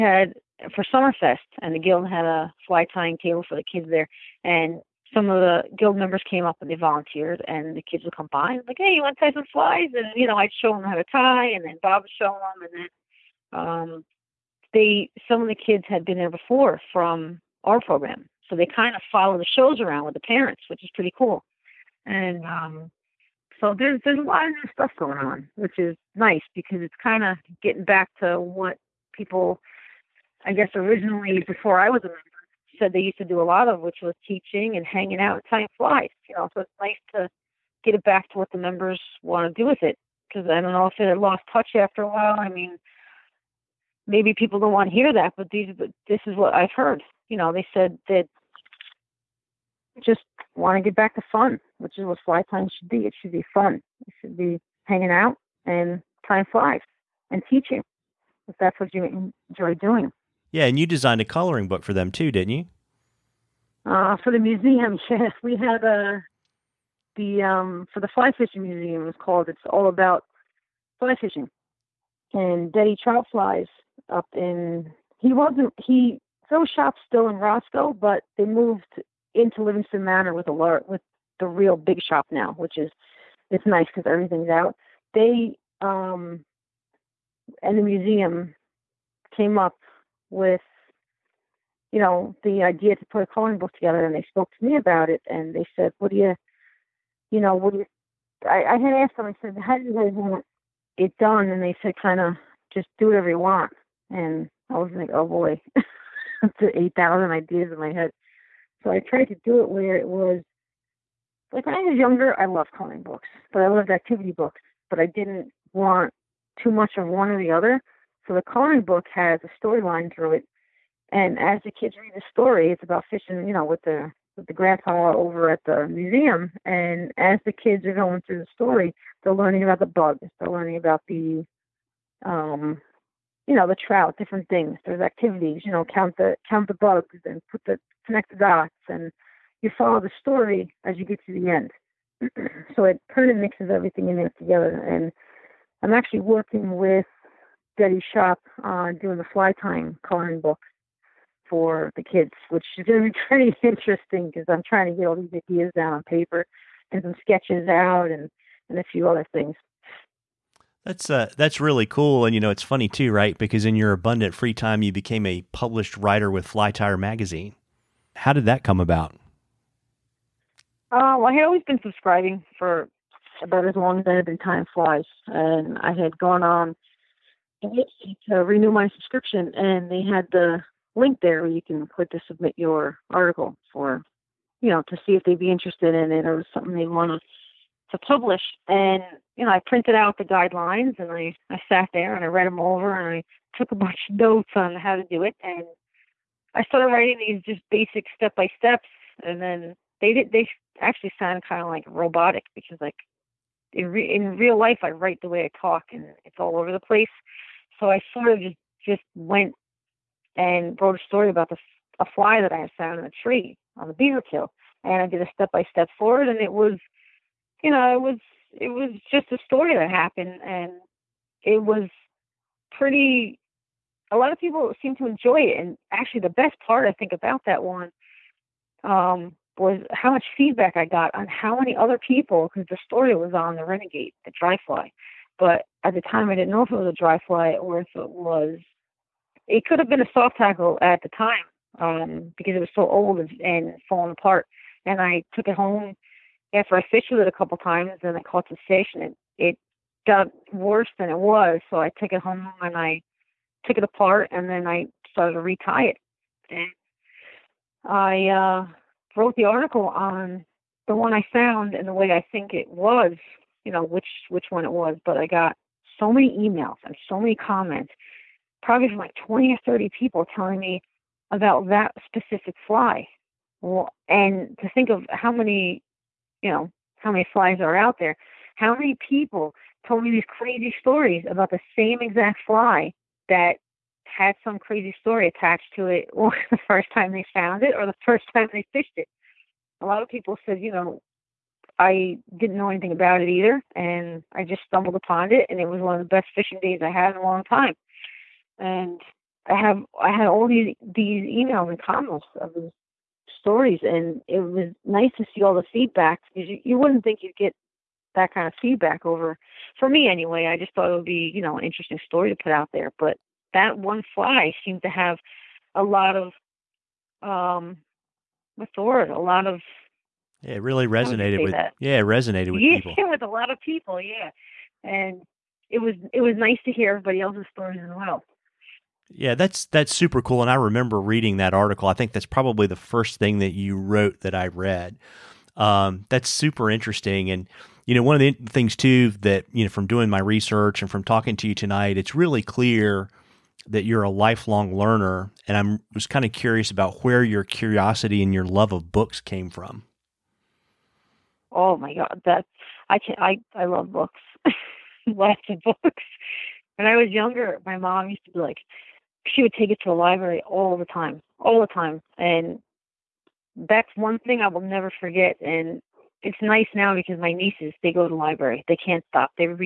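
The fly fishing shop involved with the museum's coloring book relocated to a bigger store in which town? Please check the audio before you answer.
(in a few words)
Livingston Manor.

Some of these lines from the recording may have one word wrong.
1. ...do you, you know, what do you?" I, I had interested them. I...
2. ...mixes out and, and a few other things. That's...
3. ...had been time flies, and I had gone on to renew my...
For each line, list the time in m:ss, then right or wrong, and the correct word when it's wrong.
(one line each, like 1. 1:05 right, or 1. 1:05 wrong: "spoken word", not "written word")
1. 1:36 wrong: "asked", not "interested"
2. 2:37 wrong: "sketches", not "mixes"
3. 2:54 right.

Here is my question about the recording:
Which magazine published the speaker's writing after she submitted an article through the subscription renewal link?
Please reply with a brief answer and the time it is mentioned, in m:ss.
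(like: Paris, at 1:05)
Fly Tyer, at 2:46.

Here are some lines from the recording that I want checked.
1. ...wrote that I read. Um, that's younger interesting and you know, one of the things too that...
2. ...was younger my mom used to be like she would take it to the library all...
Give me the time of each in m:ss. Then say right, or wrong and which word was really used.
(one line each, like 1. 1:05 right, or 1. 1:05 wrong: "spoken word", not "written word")
1. 5:33 wrong: "super", not "younger"
2. 5:56 right.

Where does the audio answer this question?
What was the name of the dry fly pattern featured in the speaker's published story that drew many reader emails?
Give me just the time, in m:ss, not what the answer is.
3:53.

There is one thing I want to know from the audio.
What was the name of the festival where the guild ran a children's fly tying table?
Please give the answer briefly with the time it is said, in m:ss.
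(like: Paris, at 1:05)
Summerfest, at 0:00.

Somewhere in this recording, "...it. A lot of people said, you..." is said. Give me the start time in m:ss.
4:48.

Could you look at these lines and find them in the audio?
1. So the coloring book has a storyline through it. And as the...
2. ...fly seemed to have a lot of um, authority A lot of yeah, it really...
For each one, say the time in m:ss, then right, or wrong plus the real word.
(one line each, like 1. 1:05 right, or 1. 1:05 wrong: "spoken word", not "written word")
1. 1:58 right
2. 5:14 right.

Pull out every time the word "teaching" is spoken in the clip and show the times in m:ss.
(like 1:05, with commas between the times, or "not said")
0:34, 0:57.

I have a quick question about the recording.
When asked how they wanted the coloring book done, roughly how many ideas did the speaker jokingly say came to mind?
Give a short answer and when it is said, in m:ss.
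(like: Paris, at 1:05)
8,000, at 1:46.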